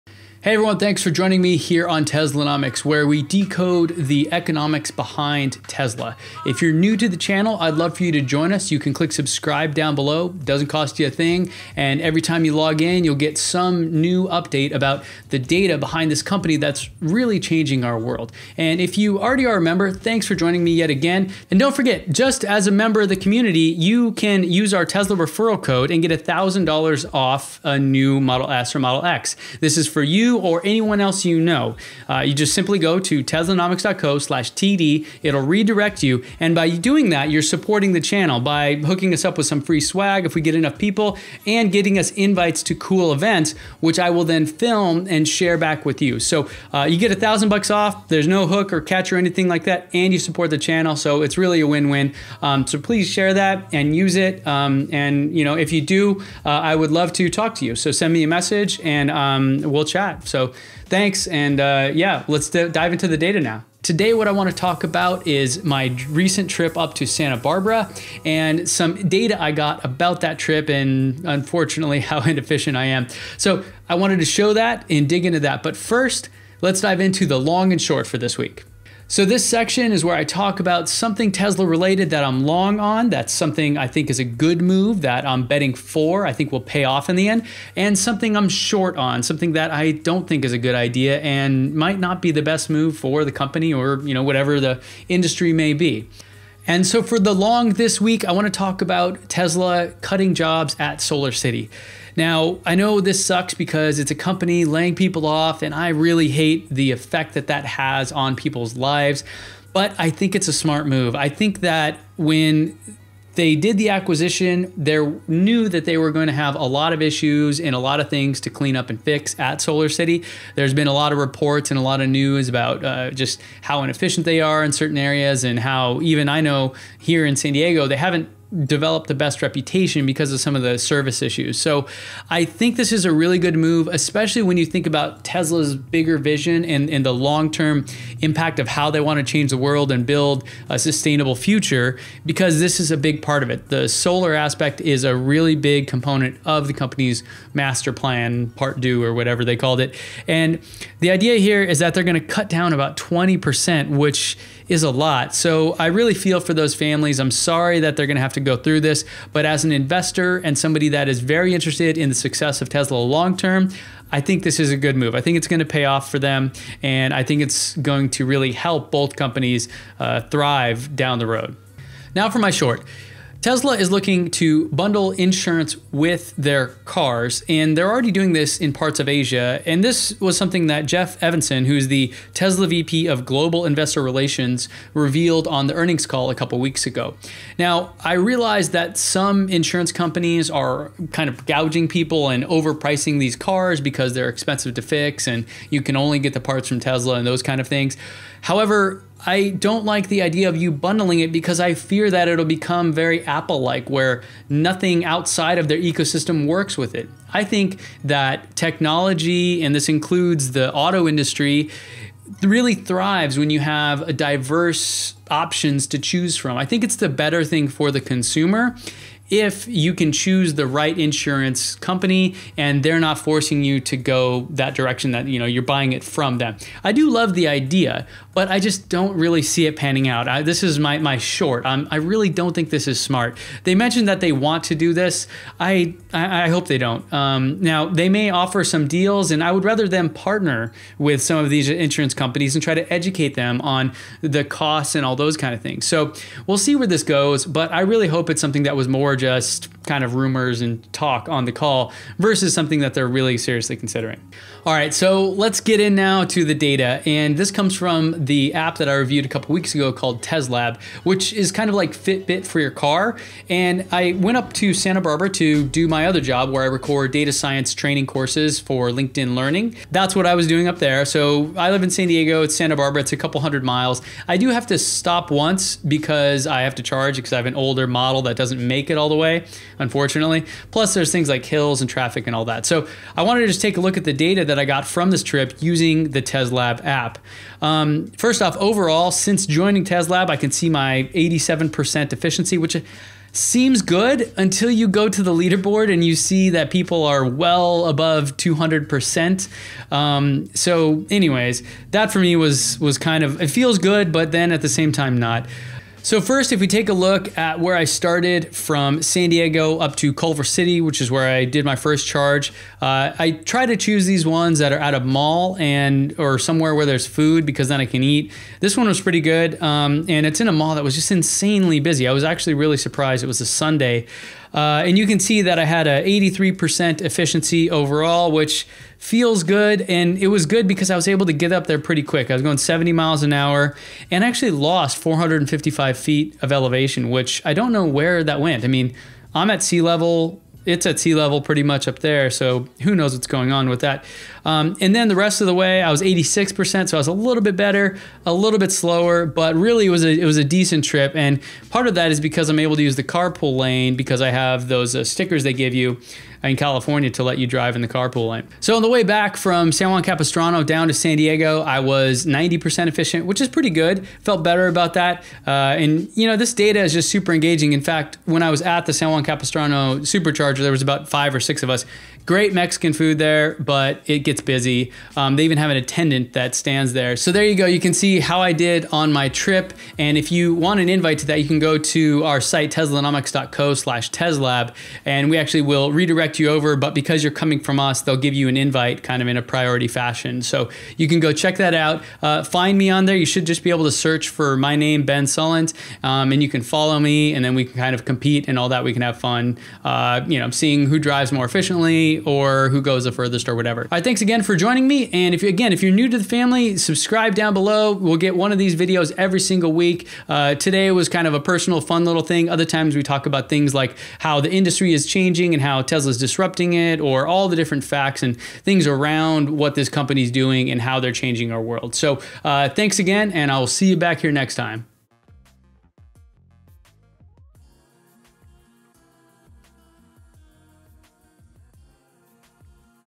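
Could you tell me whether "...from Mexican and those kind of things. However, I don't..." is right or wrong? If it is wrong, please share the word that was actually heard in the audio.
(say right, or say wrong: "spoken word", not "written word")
wrong: "Tesla", not "Mexican".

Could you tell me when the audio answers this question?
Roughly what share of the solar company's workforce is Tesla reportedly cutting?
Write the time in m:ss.
2:32.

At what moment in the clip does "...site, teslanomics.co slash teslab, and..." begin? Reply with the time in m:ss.
6:22.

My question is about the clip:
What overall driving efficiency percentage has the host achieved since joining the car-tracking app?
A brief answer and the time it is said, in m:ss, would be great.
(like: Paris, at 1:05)
87%, at 4:51.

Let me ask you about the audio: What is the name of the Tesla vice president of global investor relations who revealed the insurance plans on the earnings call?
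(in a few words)
Jeff Evanson.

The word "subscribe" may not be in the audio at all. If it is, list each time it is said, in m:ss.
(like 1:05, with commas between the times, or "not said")
0:09, 6:46.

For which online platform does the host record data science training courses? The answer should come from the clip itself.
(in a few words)
LinkedIn Learning.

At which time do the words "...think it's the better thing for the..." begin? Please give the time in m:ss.
3:36.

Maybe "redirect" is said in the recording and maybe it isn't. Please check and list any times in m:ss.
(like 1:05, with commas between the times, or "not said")
0:35, 6:25.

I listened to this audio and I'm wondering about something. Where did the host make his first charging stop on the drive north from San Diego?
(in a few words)
Culver City.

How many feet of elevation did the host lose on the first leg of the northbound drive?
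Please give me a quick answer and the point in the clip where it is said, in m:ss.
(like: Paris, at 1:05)
455 feet, at 5:34.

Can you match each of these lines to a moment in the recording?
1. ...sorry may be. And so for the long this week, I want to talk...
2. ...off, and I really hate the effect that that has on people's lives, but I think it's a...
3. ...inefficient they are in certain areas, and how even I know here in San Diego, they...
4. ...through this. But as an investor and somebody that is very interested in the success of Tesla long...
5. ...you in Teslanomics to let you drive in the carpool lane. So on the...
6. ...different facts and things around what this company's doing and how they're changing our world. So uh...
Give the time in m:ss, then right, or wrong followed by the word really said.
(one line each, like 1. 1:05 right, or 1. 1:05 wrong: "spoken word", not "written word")
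1. 1:35 wrong: "industry", not "sorry"
2. 1:45 right
3. 2:03 right
4. 2:38 right
5. 5:55 wrong: "California", not "Teslanomics"
6. 6:57 right.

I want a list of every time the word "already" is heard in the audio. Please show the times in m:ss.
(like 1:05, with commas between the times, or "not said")
0:19, 2:57.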